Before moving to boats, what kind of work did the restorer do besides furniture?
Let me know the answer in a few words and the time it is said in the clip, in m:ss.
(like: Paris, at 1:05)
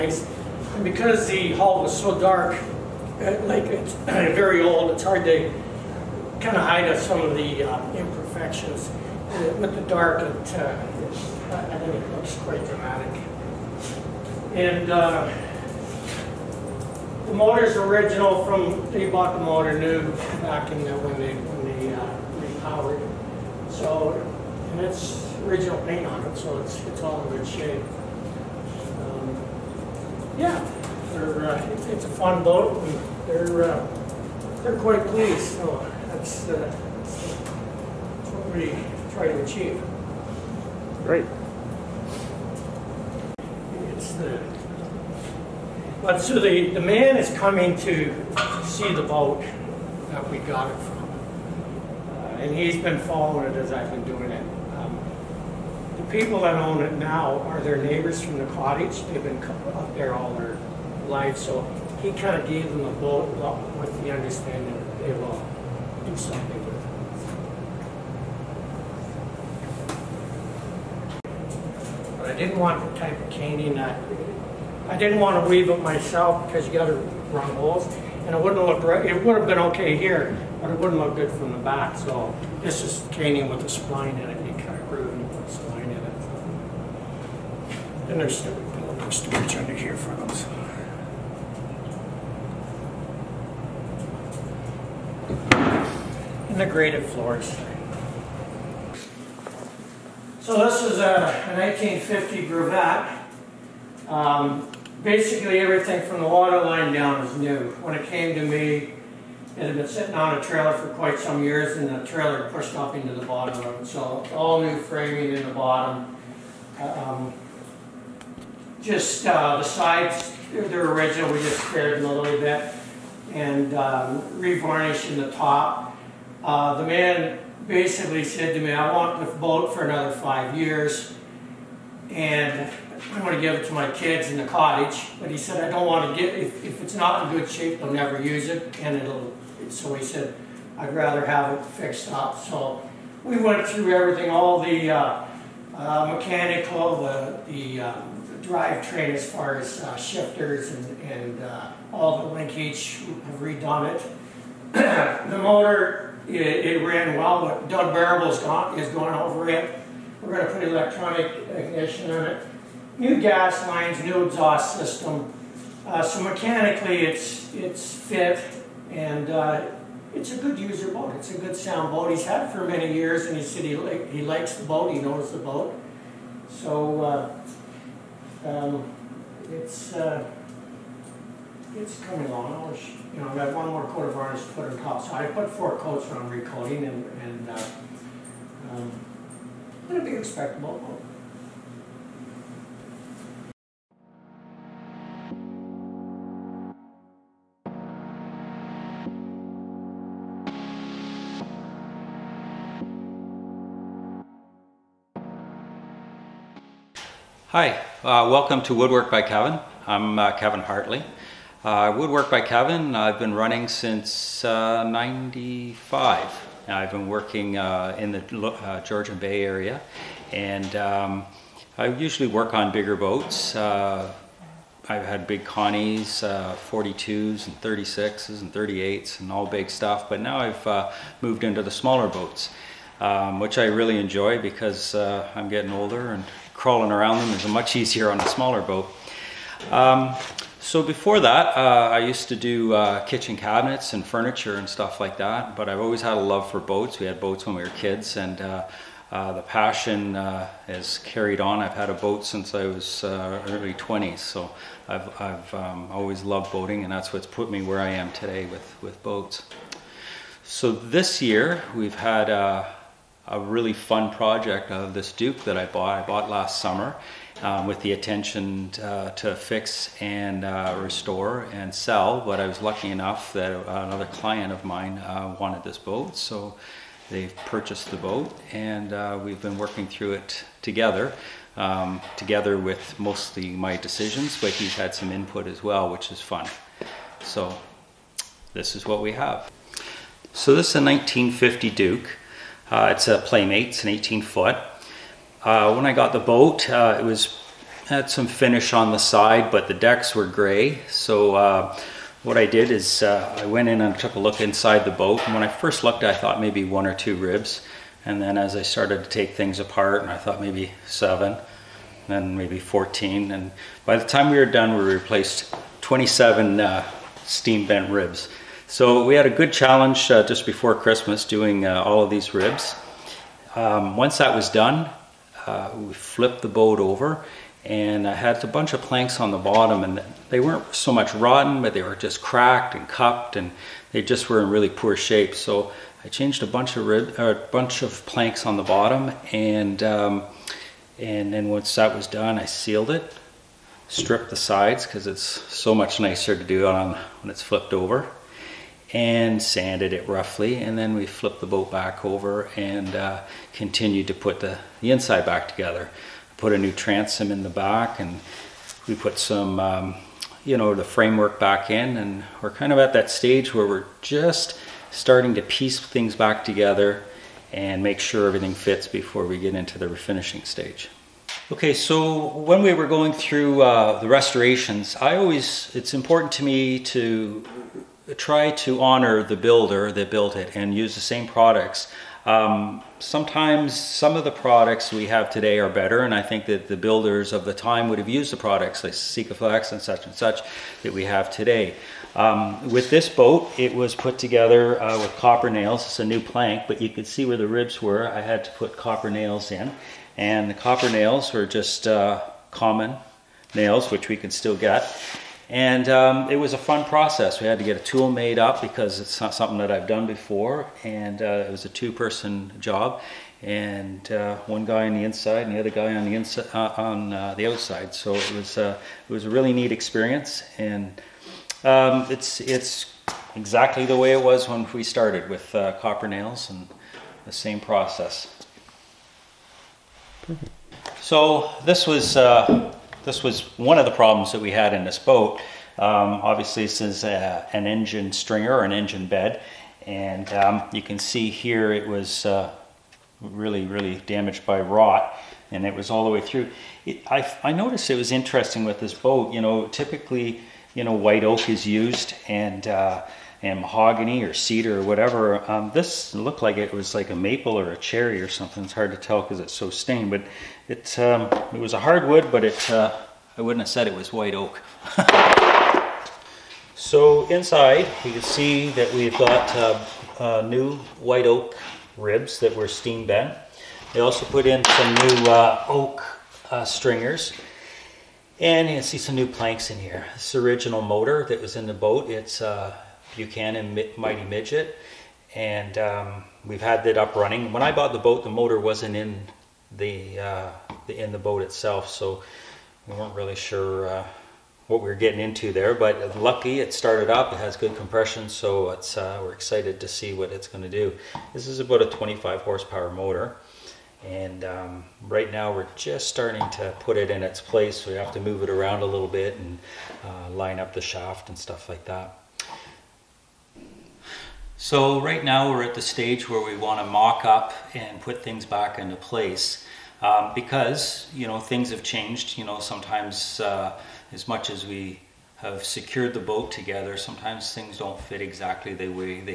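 kitchen cabinets, at 4:03.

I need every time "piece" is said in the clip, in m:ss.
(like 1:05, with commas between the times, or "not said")
6:05.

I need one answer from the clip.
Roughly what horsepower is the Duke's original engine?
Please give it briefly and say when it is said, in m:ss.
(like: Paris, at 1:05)
25, at 8:21.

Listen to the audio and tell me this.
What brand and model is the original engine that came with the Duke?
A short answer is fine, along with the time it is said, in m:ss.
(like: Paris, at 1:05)
Buchanan Mighty Midget, at 8:03.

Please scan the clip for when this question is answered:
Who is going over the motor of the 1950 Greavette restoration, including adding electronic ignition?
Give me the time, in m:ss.
2:37.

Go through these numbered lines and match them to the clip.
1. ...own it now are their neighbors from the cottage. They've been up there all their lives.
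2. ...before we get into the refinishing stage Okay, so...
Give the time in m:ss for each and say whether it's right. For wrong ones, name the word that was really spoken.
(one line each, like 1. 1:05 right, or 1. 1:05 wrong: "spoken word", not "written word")
1. 0:56 right
2. 6:08 right.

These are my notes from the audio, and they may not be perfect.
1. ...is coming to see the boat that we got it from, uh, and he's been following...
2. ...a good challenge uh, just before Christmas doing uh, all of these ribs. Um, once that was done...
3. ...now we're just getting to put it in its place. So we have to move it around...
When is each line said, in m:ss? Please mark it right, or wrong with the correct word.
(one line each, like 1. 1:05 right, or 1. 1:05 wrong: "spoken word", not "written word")
1. 0:47 right
2. 5:19 right
3. 8:25 wrong: "starting", not "getting".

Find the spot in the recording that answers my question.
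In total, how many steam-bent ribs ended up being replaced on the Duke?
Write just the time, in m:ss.
5:15.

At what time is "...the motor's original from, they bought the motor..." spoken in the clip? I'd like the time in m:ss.
0:17.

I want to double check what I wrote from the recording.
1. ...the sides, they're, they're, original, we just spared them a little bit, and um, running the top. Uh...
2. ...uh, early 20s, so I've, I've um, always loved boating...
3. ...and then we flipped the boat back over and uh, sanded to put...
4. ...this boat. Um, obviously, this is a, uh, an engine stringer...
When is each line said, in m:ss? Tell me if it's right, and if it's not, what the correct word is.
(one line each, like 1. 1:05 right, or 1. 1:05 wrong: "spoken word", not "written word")
1. 1:59 wrong: "revarnishing", not "running"
2. 4:13 right
3. 5:50 wrong: "continued", not "sanded"
4. 7:14 right.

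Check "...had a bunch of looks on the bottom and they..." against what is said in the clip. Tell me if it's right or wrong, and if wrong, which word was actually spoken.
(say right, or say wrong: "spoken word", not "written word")
wrong: "planks", not "looks".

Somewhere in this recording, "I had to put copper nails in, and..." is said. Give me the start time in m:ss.
6:38.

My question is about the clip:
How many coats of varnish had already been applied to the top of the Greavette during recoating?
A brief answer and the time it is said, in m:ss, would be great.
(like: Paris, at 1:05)
4, at 3:05.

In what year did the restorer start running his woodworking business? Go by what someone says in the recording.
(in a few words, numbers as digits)
1995.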